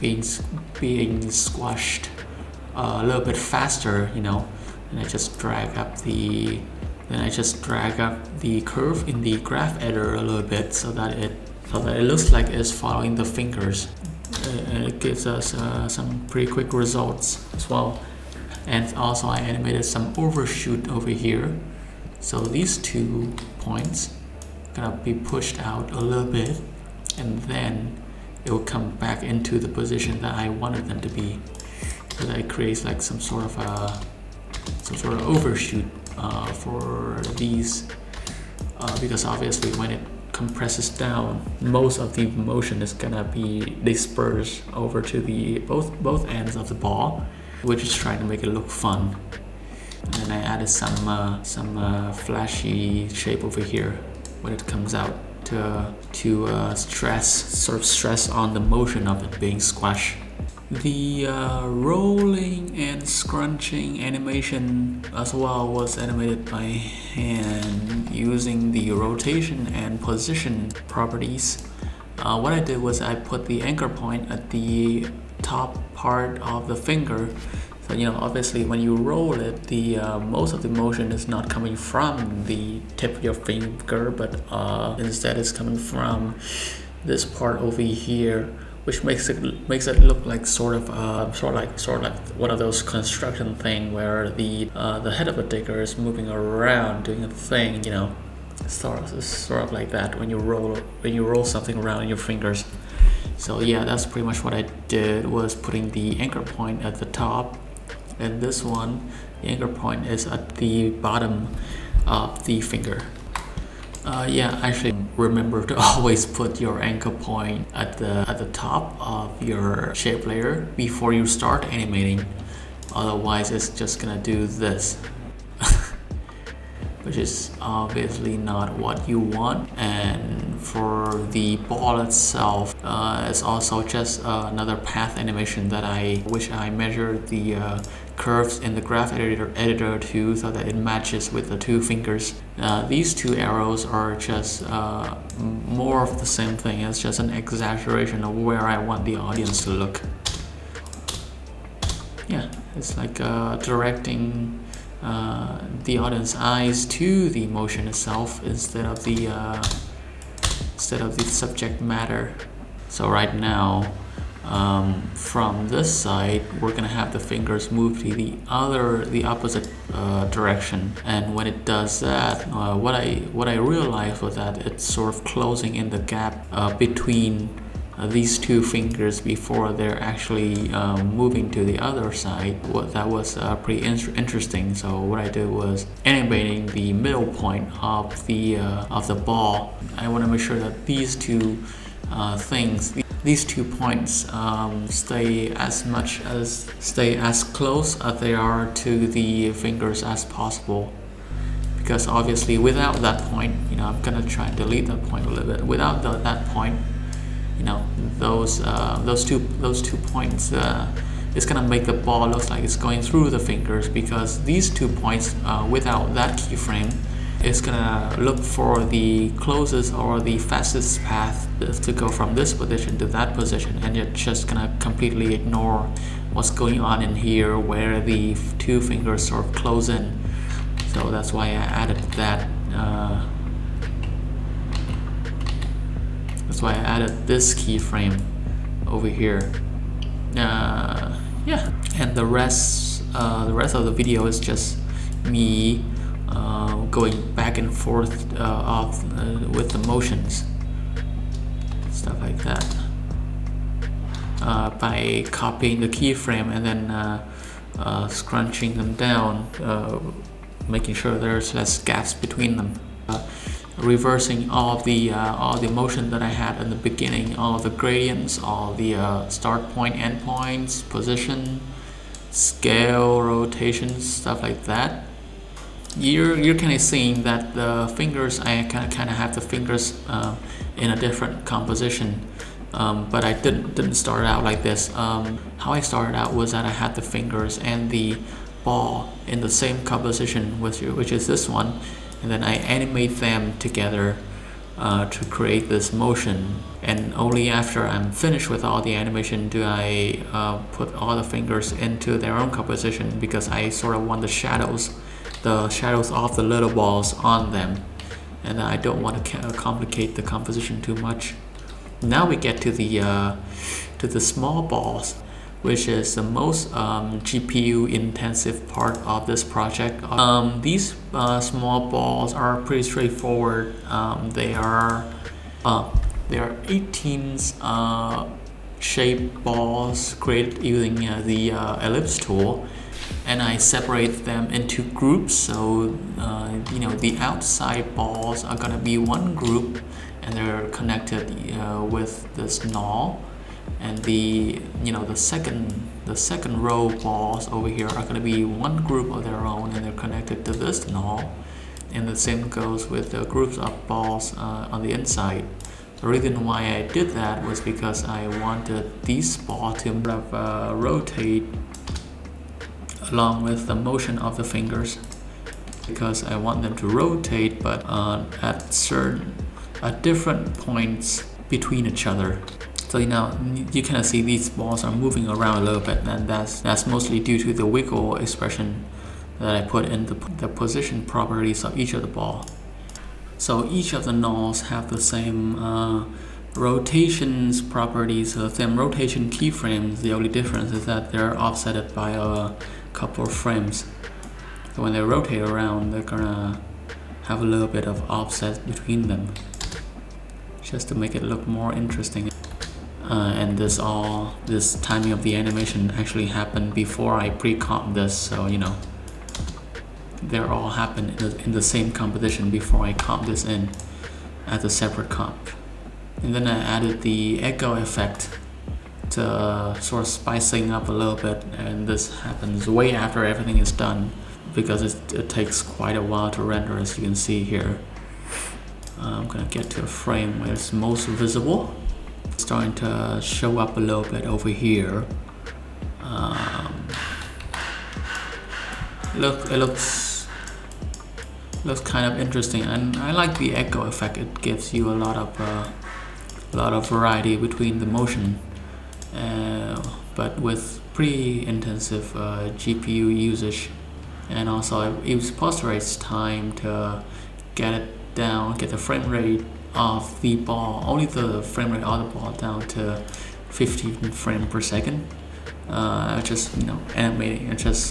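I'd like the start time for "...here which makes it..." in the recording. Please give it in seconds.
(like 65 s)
87 s.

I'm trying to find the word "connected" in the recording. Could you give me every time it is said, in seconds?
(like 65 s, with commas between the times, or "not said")
340 s, 349 s.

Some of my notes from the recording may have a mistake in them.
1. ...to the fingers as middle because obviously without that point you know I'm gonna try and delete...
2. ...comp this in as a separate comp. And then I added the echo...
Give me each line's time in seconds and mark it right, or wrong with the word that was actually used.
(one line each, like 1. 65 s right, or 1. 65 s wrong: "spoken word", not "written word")
1. 198 s wrong: "possible", not "middle"
2. 412 s right.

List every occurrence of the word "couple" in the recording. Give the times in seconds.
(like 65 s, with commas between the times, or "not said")
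392 s.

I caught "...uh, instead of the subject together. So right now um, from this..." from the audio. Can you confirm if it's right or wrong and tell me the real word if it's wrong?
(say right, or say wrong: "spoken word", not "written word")
wrong: "matter", not "together".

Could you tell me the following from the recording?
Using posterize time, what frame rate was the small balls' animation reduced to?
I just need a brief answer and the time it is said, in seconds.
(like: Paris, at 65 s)
15 frames per second, at 463 s.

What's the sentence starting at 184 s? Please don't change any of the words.
So what I did was animating the middle point of the uh, of the ball.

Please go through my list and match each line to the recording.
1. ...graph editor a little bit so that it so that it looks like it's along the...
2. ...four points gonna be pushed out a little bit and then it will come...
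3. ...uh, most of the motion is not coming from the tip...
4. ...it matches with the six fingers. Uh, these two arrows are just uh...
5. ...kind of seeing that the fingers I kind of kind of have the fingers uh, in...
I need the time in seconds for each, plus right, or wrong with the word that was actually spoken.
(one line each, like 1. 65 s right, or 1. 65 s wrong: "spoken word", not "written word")
1. 9 s wrong: "following", not "along"
2. 22 s wrong: "two", not "four"
3. 79 s right
4. 140 s wrong: "two", not "six"
5. 276 s right.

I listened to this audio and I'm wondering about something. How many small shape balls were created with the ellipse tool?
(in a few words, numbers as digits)
18.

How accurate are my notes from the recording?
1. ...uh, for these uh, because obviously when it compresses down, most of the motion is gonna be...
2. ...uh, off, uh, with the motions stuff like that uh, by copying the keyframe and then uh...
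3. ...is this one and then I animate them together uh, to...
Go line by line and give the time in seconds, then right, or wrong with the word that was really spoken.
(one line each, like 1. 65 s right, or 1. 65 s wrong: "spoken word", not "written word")
1. 36 s right
2. 248 s right
3. 291 s right.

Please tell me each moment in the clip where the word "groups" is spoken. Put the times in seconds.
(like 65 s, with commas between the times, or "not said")
334 s, 339 s, 348 s, 353 s.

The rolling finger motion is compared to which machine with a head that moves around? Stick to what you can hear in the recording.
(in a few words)
a digger.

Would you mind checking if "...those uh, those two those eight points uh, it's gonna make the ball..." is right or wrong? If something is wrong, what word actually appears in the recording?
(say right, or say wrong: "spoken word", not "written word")
wrong: "two", not "eight".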